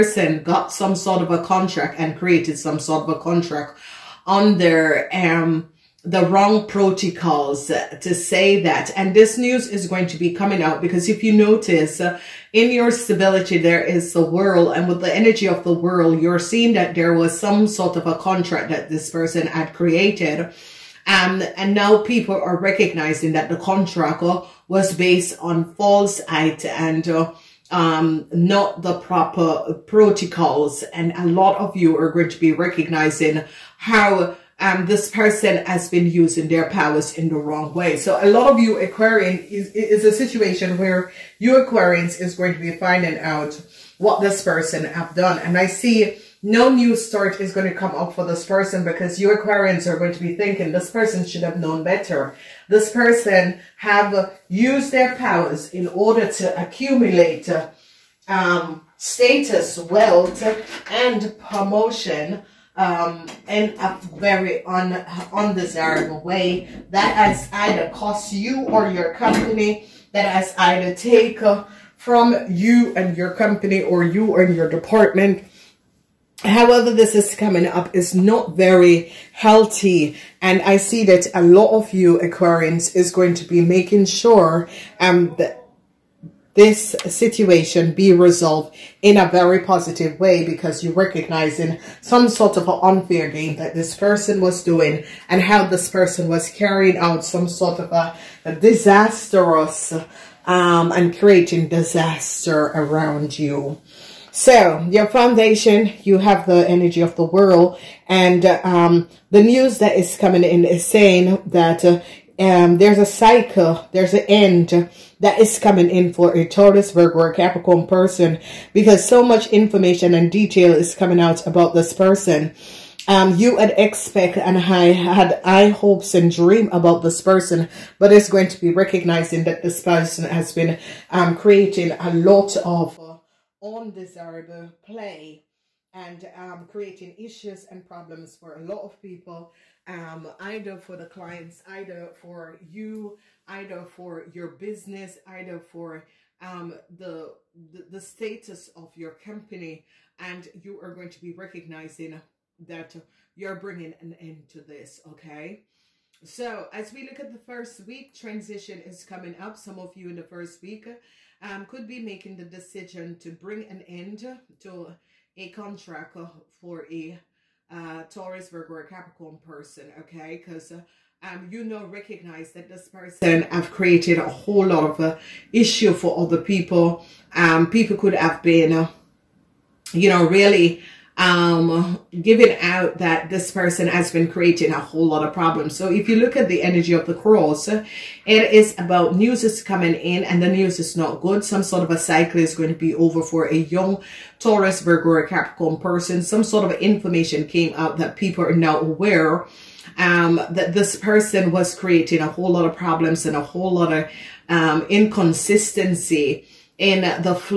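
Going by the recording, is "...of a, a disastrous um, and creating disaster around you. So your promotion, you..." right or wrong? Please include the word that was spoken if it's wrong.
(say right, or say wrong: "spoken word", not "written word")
wrong: "foundation", not "promotion".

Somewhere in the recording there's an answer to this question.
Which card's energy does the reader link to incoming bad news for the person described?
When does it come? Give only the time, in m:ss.
3:07.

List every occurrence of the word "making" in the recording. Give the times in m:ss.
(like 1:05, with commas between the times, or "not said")
1:23, 2:41.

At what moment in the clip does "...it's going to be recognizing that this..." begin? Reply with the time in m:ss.
2:08.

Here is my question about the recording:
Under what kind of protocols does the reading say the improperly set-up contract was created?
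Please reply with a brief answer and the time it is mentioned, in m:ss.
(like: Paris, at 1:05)
wrong protocols, at 0:06.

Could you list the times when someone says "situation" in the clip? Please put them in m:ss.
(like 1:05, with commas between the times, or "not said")
0:40, 1:27.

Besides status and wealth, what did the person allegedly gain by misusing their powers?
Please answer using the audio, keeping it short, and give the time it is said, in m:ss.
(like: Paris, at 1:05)
promotion, at 1:01.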